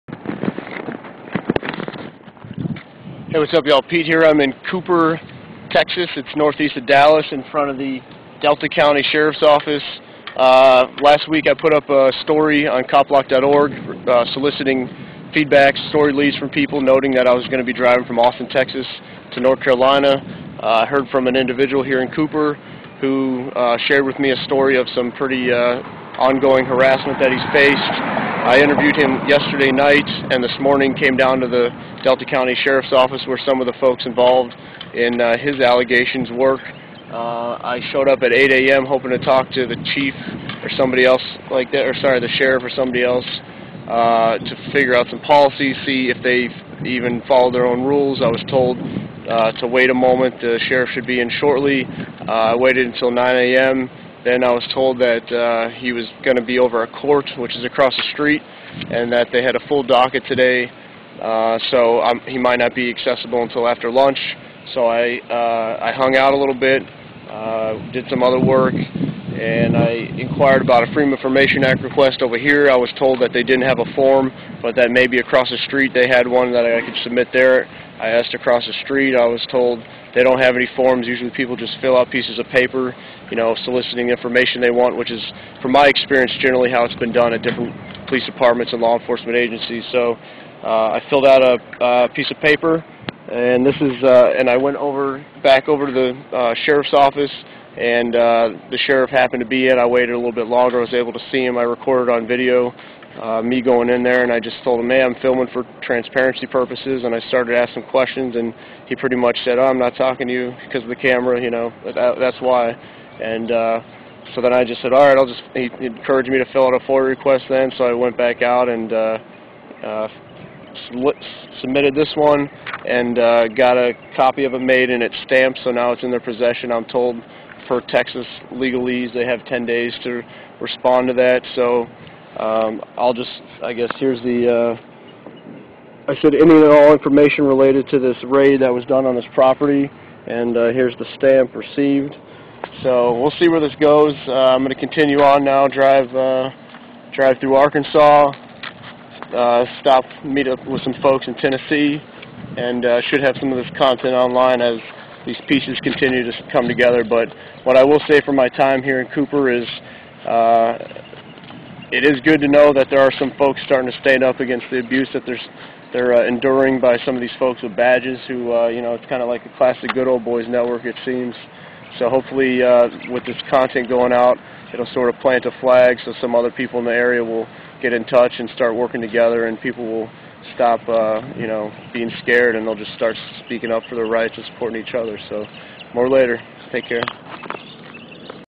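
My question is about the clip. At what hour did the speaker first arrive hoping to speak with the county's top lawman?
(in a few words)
8 a.m.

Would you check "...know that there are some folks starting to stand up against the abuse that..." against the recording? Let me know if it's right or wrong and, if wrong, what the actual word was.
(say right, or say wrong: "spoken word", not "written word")
right.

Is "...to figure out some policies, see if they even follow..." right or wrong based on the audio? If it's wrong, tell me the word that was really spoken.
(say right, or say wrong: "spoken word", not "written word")
right.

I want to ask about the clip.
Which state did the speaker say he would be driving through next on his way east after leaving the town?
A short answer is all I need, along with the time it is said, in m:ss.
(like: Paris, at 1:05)
Arkansas, at 2:27.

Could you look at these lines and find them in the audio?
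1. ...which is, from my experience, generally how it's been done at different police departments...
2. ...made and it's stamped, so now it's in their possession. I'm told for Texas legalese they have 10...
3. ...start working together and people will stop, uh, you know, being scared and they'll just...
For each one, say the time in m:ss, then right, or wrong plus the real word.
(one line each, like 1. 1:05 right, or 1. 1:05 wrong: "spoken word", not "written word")
1. 1:24 right
2. 2:04 right
3. 2:58 right.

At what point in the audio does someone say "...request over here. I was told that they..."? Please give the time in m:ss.
1:11.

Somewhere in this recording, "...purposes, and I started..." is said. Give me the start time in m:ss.
1:46.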